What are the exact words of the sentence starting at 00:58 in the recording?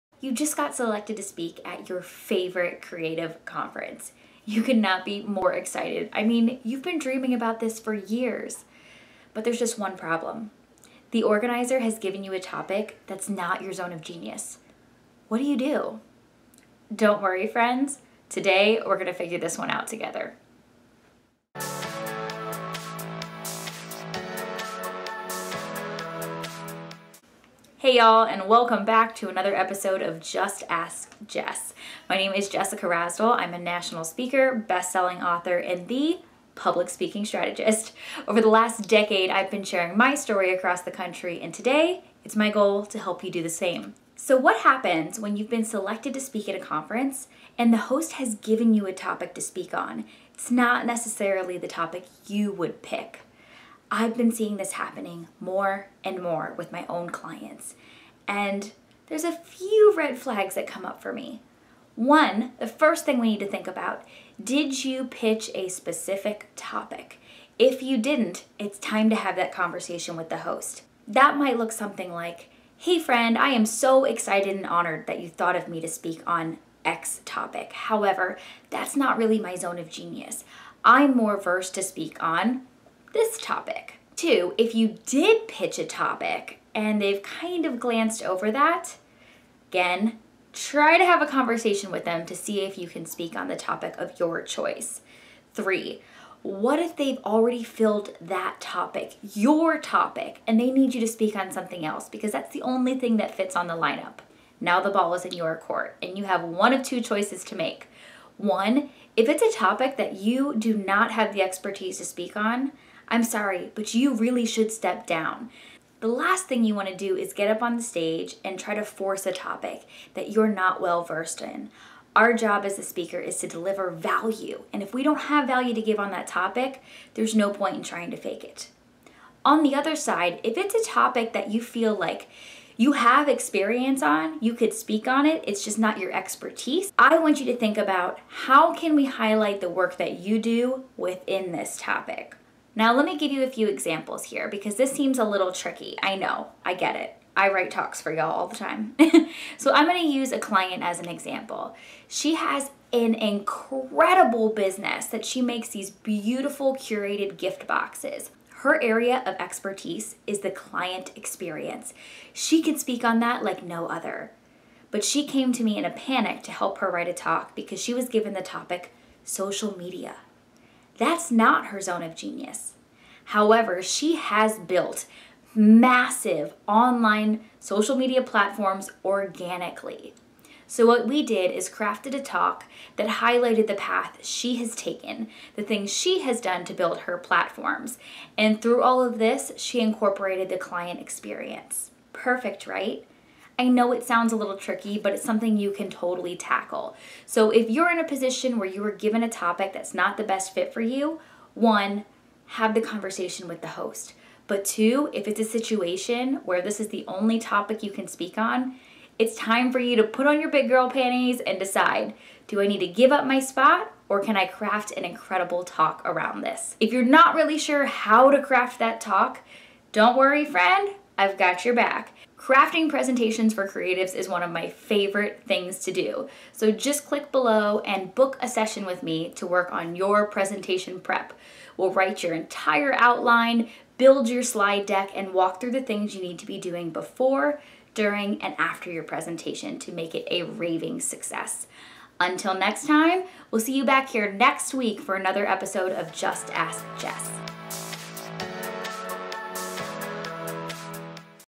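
And there's a few red flags that come up for me.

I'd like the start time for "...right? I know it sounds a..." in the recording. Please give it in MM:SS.
03:12.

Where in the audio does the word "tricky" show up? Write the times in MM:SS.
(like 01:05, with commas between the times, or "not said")
02:25, 03:14.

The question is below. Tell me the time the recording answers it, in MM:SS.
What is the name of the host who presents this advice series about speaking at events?
00:32.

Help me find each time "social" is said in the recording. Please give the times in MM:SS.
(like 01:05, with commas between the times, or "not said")
02:49, 02:57.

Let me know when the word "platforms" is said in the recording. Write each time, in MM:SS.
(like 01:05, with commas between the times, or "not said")
02:58, 03:07.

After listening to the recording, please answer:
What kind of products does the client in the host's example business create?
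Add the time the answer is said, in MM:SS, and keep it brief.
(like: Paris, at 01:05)
curated gift boxes, at 02:36.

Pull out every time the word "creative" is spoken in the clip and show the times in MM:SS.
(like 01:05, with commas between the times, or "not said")
00:02, 03:43.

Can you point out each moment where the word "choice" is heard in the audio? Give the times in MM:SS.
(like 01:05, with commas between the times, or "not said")
01:34, 01:47.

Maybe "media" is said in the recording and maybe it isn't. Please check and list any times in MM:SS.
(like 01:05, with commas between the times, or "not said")
02:49, 02:57.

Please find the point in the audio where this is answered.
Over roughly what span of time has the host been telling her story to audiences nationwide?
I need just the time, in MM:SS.
00:38.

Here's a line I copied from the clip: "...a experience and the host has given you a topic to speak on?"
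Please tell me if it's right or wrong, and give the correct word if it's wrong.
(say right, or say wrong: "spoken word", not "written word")
wrong: "conference", not "experience".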